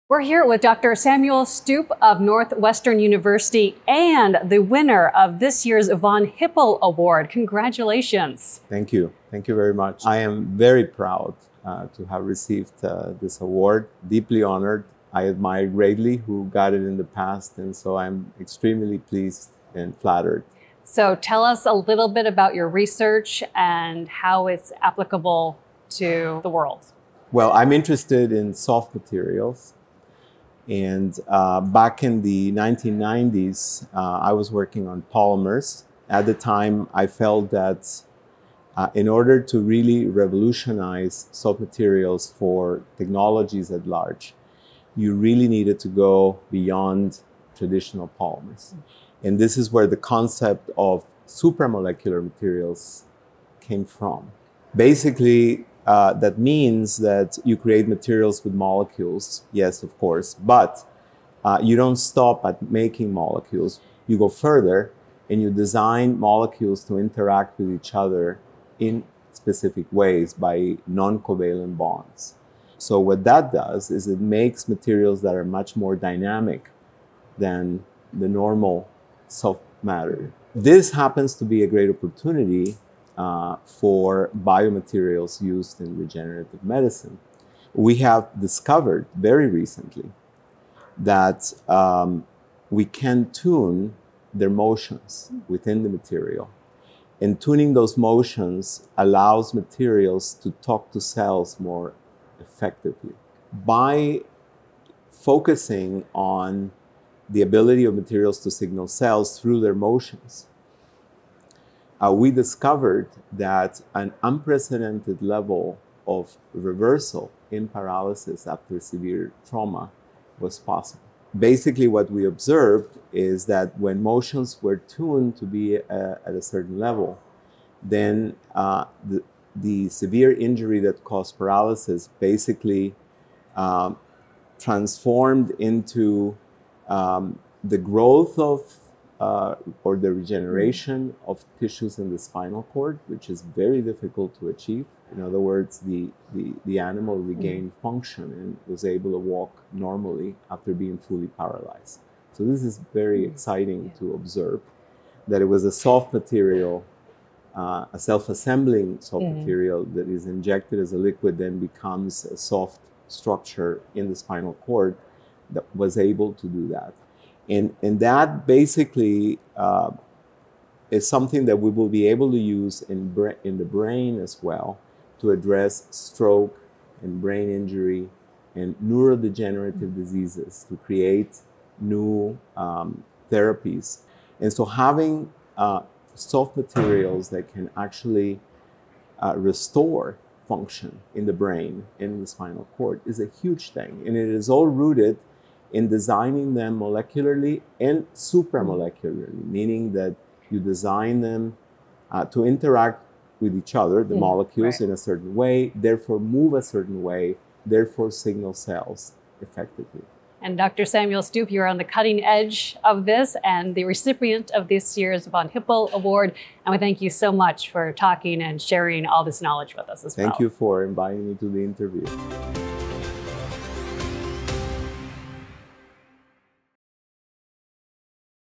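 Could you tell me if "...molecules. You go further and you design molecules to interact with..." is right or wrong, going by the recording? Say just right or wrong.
right.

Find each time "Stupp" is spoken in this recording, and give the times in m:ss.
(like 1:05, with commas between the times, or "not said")
0:01, 3:31.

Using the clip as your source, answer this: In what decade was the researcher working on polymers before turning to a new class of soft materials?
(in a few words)
1990s.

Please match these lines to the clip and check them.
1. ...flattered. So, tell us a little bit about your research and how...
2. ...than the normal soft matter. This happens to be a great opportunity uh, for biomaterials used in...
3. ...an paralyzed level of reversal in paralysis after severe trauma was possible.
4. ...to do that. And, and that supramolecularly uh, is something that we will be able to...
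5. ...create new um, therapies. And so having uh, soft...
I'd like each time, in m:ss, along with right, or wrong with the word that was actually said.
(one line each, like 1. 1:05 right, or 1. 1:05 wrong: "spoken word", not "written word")
1. 0:19 right
2. 1:17 right
3. 1:53 wrong: "unprecedented", not "paralyzed"
4. 2:46 wrong: "basically", not "supramolecularly"
5. 3:00 right.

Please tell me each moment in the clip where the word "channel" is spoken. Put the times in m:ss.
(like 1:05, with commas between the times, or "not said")
not said.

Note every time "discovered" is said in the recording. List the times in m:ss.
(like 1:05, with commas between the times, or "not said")
1:28, 1:52.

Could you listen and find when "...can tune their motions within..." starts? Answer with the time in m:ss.
1:32.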